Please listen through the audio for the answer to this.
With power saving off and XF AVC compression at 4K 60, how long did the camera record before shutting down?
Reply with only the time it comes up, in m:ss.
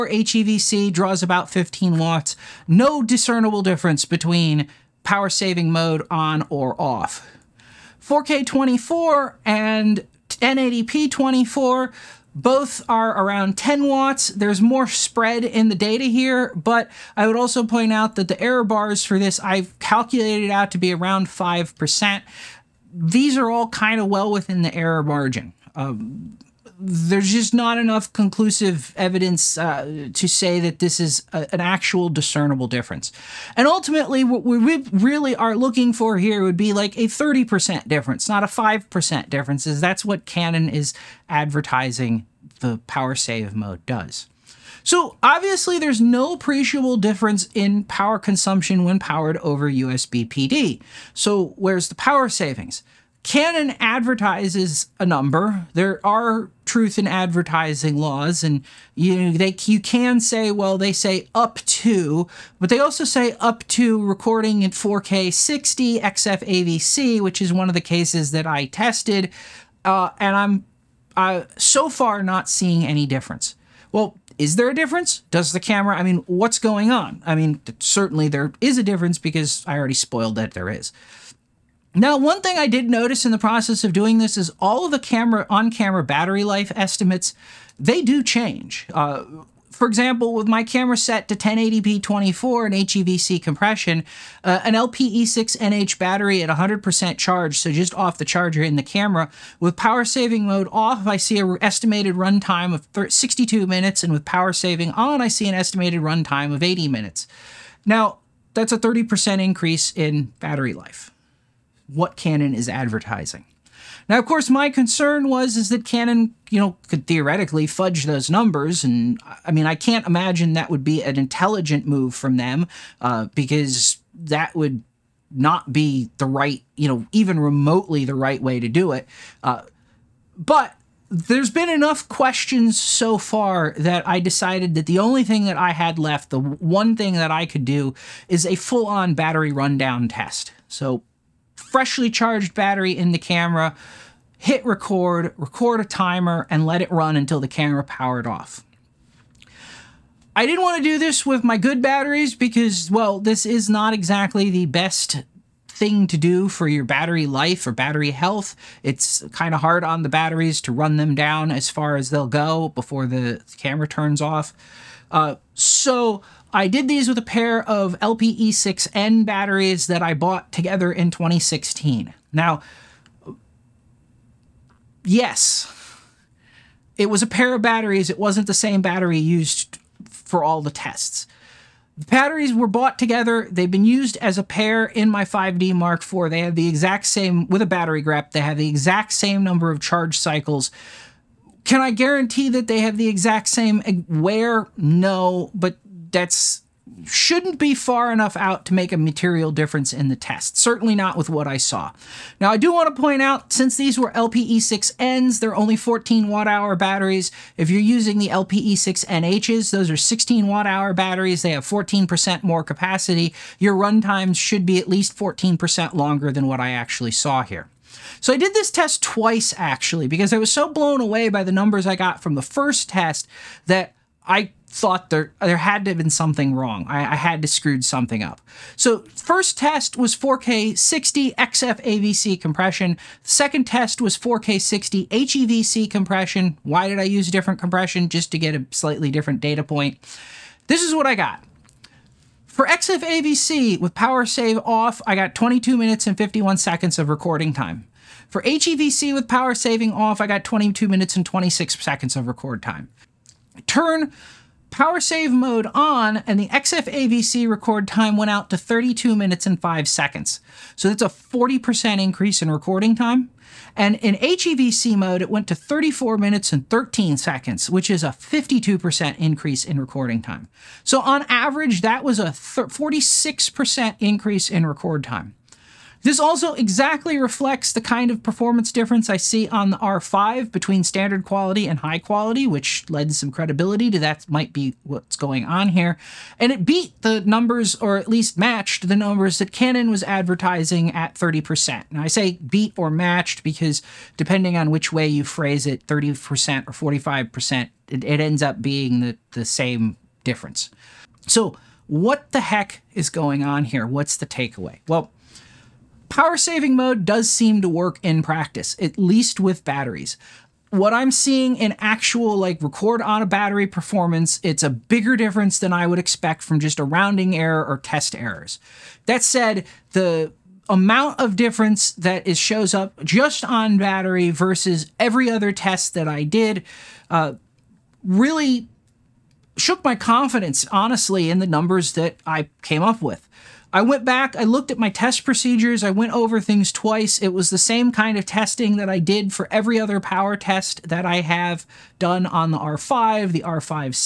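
4:05.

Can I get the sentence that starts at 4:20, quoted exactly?
So that's a 40% increase in recording time.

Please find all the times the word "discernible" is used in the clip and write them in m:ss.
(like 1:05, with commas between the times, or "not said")
0:03, 0:32.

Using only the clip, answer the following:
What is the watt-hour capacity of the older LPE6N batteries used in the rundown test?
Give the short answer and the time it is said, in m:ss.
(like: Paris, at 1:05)
14 watt hours, at 3:25.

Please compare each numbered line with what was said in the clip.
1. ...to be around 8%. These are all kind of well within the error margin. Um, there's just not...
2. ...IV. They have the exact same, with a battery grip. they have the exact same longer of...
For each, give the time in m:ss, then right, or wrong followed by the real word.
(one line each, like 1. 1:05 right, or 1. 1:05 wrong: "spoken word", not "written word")
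1. 0:20 wrong: "5", not "8"
2. 3:06 wrong: "number", not "longer".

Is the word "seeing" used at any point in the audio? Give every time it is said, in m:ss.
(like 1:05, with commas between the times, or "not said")
1:12, 5:11.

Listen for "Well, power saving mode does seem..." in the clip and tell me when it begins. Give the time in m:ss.
5:04.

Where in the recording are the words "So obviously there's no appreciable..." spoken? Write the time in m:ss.
0:44.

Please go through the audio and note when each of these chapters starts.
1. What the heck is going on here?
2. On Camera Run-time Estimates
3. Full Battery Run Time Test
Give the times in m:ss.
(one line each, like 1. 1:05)
1. 4:59
2. 1:19
3. 2:19.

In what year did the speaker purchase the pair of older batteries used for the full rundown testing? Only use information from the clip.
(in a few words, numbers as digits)
2016.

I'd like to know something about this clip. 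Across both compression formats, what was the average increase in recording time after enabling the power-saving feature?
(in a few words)
46%.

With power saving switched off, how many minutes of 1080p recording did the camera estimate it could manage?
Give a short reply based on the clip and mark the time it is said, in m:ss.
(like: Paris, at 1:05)
62 minutes, at 1:43.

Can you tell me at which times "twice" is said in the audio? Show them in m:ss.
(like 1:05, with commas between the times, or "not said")
3:39, 5:36.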